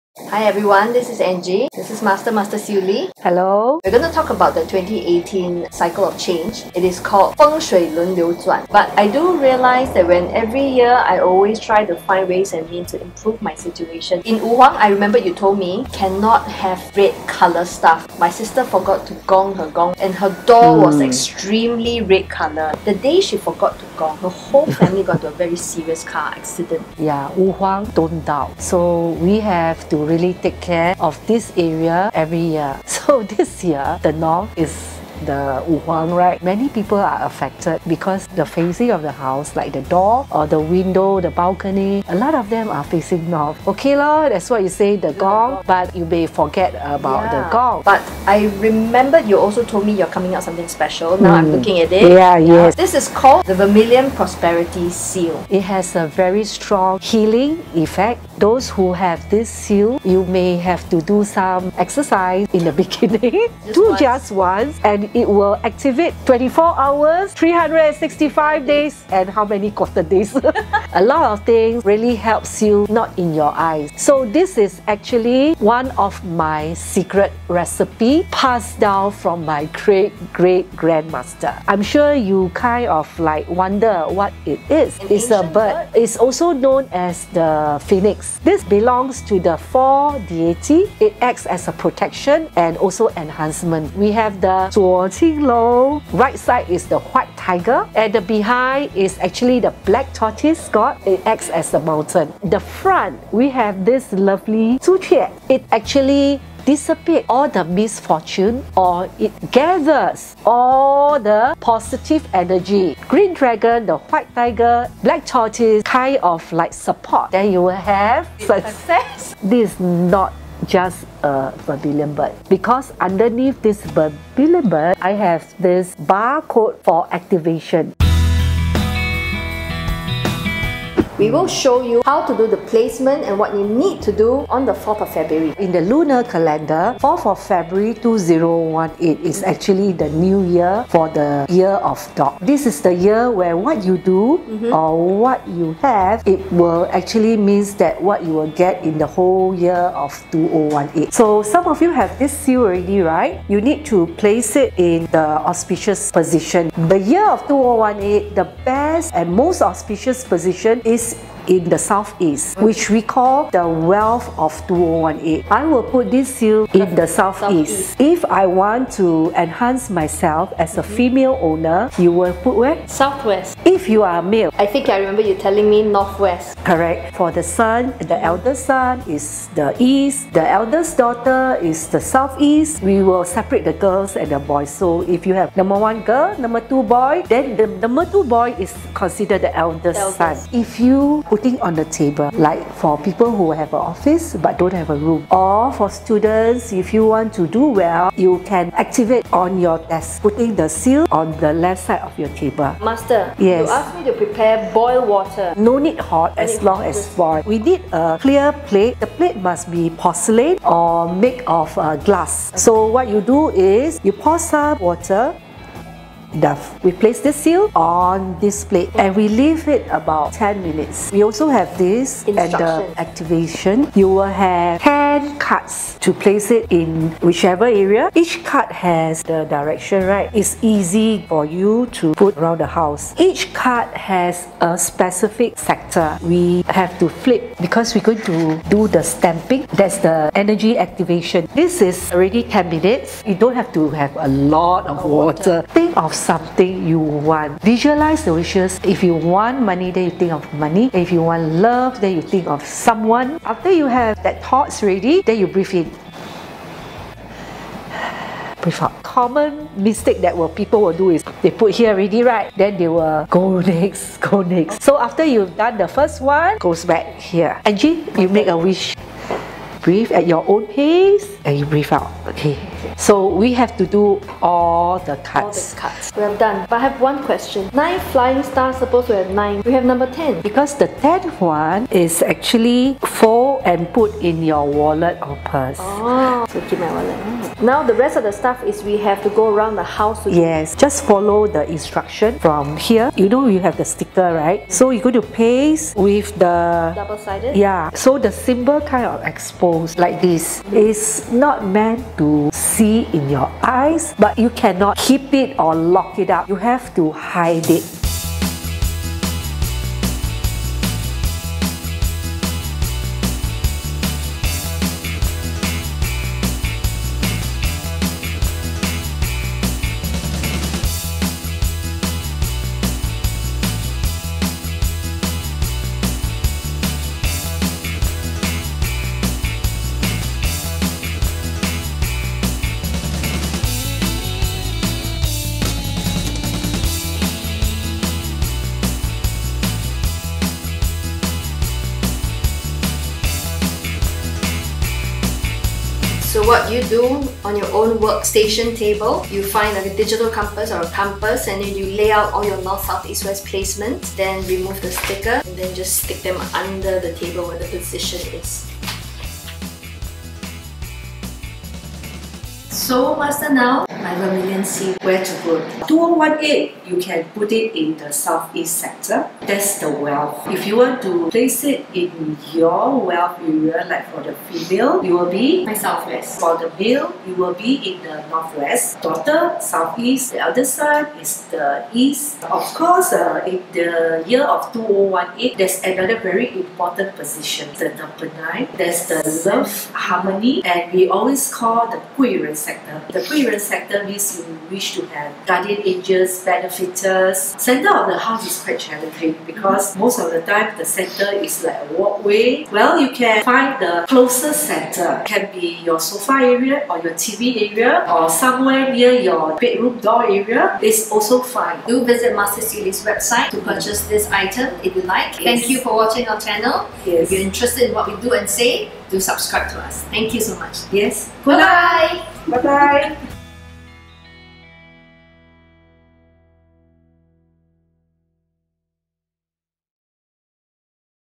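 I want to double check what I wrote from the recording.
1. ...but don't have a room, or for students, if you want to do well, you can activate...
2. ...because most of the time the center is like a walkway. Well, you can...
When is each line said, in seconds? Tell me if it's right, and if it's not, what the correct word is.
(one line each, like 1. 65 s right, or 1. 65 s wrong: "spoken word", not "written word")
1. 194 s right
2. 399 s right.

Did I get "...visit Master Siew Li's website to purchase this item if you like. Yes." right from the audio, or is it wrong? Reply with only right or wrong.
right.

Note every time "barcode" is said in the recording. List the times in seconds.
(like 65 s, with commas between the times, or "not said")
125 s.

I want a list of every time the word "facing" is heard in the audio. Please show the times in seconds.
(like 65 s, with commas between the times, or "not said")
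38 s, 42 s.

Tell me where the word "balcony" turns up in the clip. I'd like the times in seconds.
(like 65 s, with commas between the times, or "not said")
41 s.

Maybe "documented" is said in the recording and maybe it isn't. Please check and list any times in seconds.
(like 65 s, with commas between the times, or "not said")
not said.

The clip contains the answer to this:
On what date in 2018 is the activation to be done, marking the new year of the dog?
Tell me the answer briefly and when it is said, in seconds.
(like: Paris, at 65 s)
4th February, at 134 s.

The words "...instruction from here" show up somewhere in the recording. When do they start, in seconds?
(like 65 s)
291 s.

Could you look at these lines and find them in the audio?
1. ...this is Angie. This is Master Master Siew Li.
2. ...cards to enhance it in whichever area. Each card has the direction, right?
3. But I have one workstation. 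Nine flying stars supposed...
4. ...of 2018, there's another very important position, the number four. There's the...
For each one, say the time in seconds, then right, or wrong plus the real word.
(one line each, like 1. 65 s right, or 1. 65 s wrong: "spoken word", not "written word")
1. 0 s right
2. 225 s wrong: "place", not "enhance"
3. 276 s wrong: "question", not "workstation"
4. 384 s wrong: "nine", not "four".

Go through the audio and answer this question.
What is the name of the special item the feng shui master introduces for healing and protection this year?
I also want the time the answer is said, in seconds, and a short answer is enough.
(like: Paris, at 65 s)
Vermilion Prosperity Seal, at 53 s.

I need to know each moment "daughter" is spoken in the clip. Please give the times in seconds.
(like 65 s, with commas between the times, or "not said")
180 s, 379 s.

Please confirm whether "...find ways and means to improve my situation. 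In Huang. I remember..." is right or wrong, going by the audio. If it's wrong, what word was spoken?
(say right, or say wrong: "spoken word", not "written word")
right.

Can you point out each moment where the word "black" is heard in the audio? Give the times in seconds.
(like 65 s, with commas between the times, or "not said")
99 s, 115 s.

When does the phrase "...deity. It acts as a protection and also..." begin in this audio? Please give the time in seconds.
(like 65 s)
90 s.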